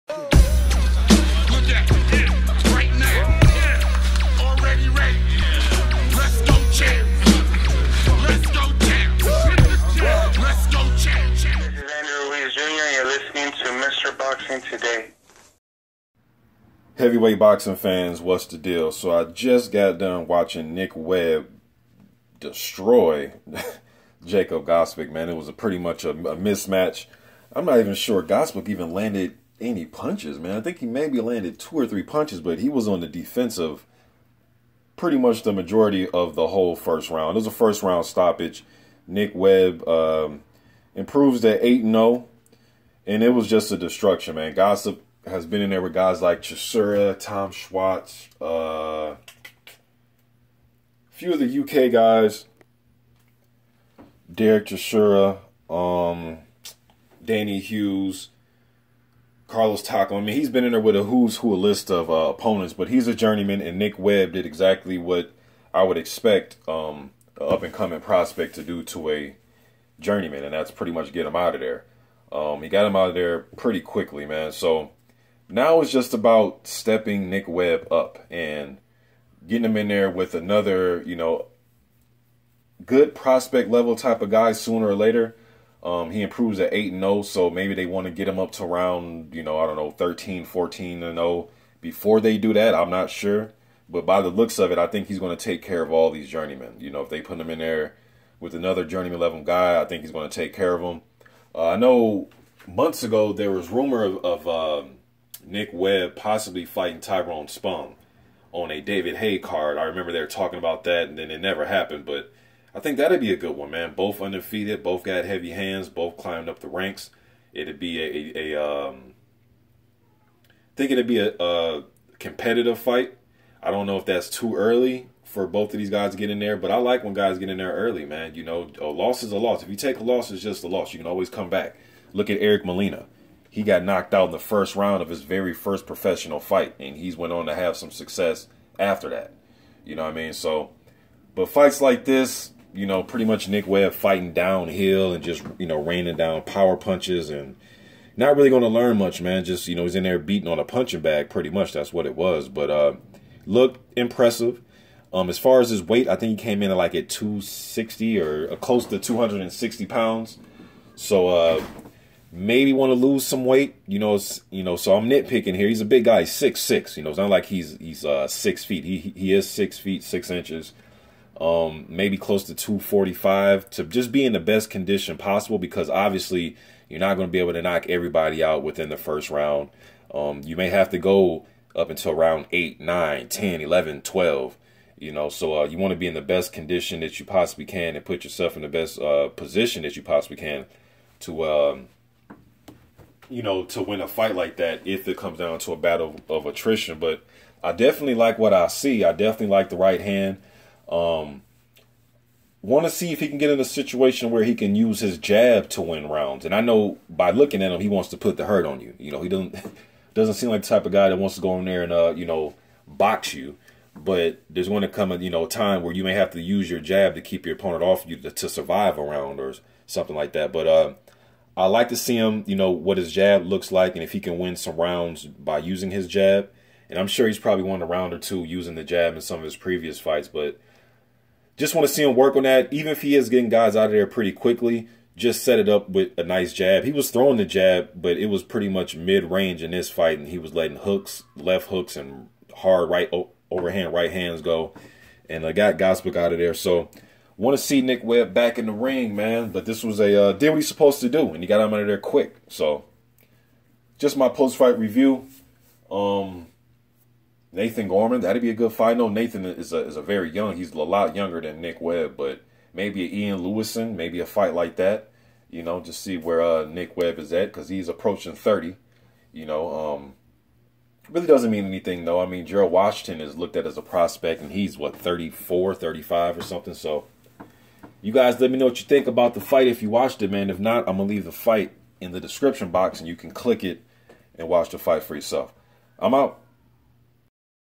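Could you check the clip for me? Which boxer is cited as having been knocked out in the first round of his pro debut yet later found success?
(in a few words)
Eric Molina.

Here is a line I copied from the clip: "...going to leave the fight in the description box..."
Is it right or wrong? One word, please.
right.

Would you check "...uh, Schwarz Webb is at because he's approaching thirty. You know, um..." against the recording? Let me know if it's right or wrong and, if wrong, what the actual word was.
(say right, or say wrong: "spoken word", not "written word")
wrong: "Nick", not "Schwarz".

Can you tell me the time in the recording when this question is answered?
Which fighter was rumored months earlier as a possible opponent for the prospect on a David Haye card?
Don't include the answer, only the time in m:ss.
1:47.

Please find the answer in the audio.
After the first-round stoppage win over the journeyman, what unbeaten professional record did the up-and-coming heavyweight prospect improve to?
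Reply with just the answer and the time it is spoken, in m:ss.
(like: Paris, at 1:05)
8-0, at 0:41.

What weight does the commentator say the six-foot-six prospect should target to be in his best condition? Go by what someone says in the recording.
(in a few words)
245 pounds.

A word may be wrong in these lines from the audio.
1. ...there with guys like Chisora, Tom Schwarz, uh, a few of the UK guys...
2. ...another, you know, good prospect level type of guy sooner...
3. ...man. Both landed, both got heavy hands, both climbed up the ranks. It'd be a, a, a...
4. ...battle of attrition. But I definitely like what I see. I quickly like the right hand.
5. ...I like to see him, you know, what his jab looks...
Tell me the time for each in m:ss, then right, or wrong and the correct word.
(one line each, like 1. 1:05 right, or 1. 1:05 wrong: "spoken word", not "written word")
1. 0:45 right
2. 1:20 right
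3. 1:53 wrong: "undefeated", not "landed"
4. 3:15 wrong: "definitely", not "quickly"
5. 3:41 right.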